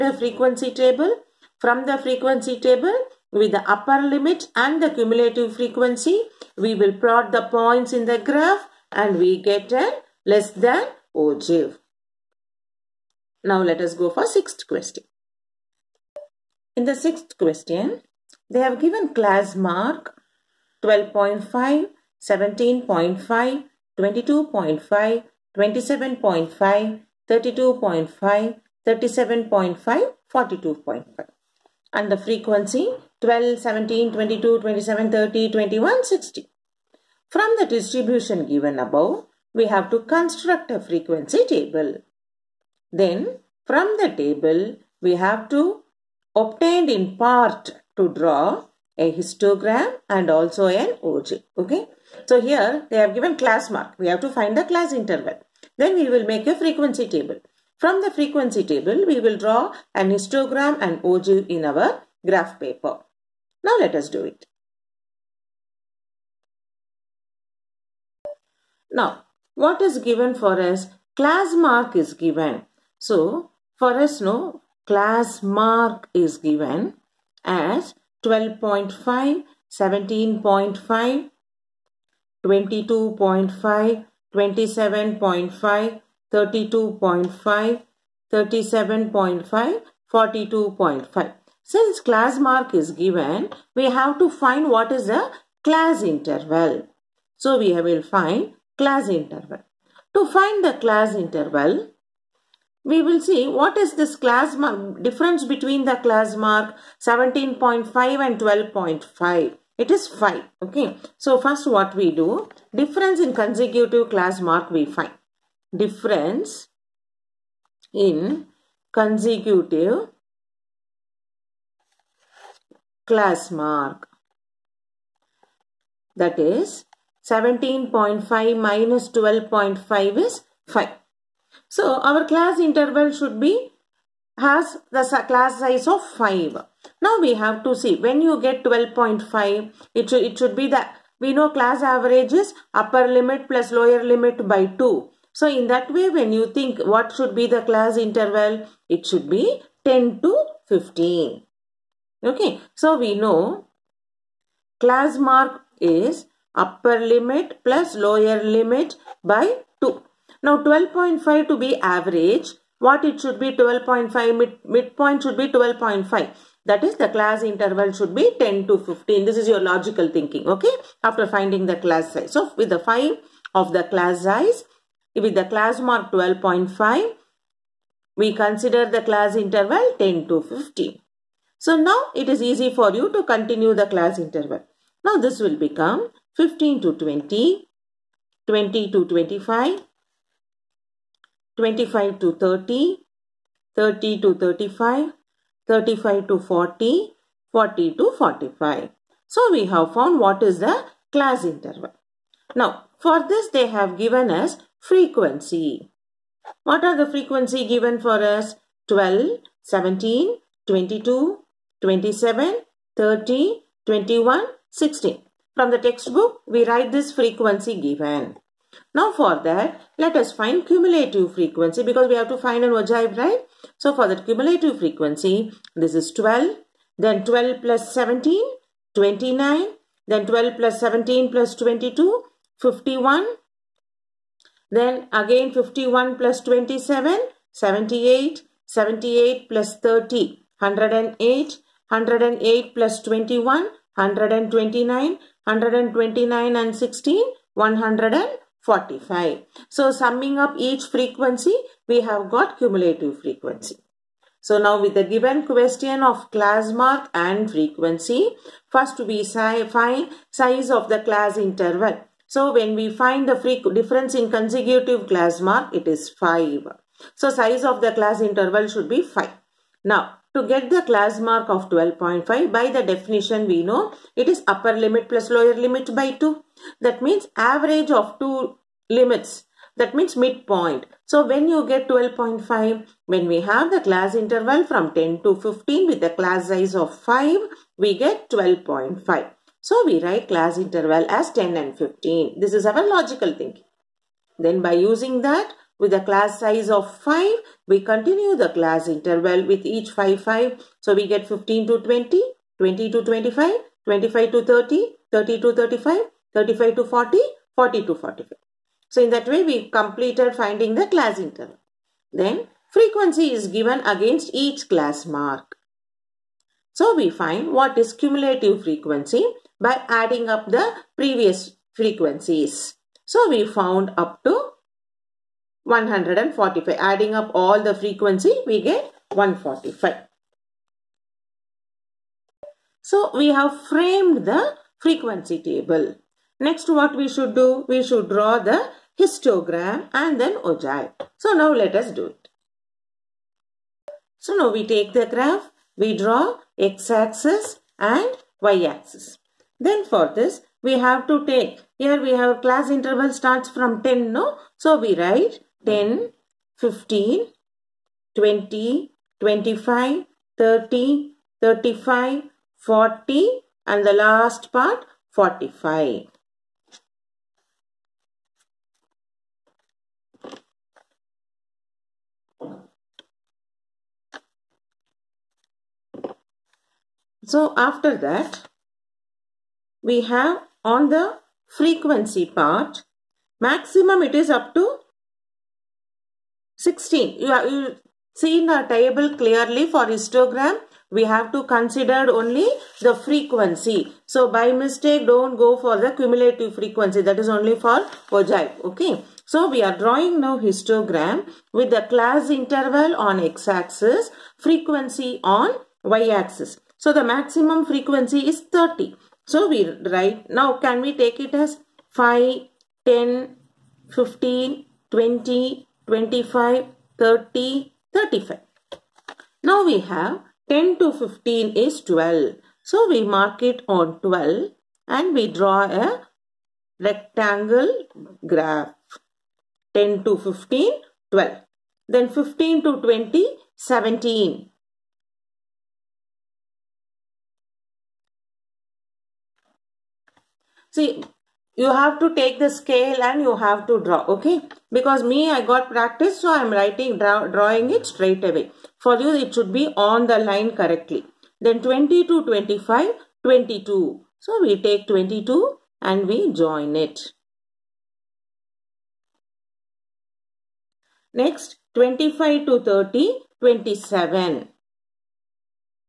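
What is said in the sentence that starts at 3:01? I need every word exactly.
So now it is easy for you to continue the class interval.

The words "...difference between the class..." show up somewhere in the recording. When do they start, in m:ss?
1:45.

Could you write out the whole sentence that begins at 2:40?
Now 12.5 to be average, what it should be 12.5, mid, midpoint should be 12.5.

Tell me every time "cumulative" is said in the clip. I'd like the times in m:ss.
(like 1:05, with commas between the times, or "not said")
0:04, 4:12, 5:17, 6:35.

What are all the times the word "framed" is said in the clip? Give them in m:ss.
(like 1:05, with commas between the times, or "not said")
5:33.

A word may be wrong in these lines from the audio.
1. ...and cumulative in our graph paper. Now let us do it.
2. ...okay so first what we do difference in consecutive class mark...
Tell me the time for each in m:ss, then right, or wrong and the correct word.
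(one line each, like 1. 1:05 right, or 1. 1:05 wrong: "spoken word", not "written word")
1. 1:00 wrong: "ogive", not "cumulative"
2. 1:50 right.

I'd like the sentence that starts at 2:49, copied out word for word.
This is your logical thinking, okay?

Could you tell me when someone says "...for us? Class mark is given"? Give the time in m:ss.
1:10.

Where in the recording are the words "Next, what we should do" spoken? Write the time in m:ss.
5:36.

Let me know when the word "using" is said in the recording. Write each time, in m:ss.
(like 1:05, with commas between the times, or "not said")
4:54.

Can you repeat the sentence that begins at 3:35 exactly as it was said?
From the textbook we write this frequency given.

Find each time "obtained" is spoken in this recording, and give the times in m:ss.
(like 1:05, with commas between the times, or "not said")
0:46.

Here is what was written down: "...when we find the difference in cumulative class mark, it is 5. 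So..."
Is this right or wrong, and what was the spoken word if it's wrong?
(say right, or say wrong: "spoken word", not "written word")
wrong: "consecutive", not "cumulative".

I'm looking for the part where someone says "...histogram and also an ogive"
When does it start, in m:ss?
0:49.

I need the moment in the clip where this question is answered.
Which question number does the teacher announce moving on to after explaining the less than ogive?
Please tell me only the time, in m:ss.
0:14.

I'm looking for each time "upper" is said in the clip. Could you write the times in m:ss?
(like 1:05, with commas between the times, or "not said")
0:03, 2:22, 2:36, 4:34.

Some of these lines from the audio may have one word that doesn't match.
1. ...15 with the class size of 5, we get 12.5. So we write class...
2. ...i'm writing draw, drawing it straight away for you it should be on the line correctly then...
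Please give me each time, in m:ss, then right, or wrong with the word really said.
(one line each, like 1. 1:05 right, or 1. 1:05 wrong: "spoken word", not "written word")
1. 4:45 right
2. 7:26 right.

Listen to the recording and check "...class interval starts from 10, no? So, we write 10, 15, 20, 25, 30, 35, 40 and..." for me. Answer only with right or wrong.
right.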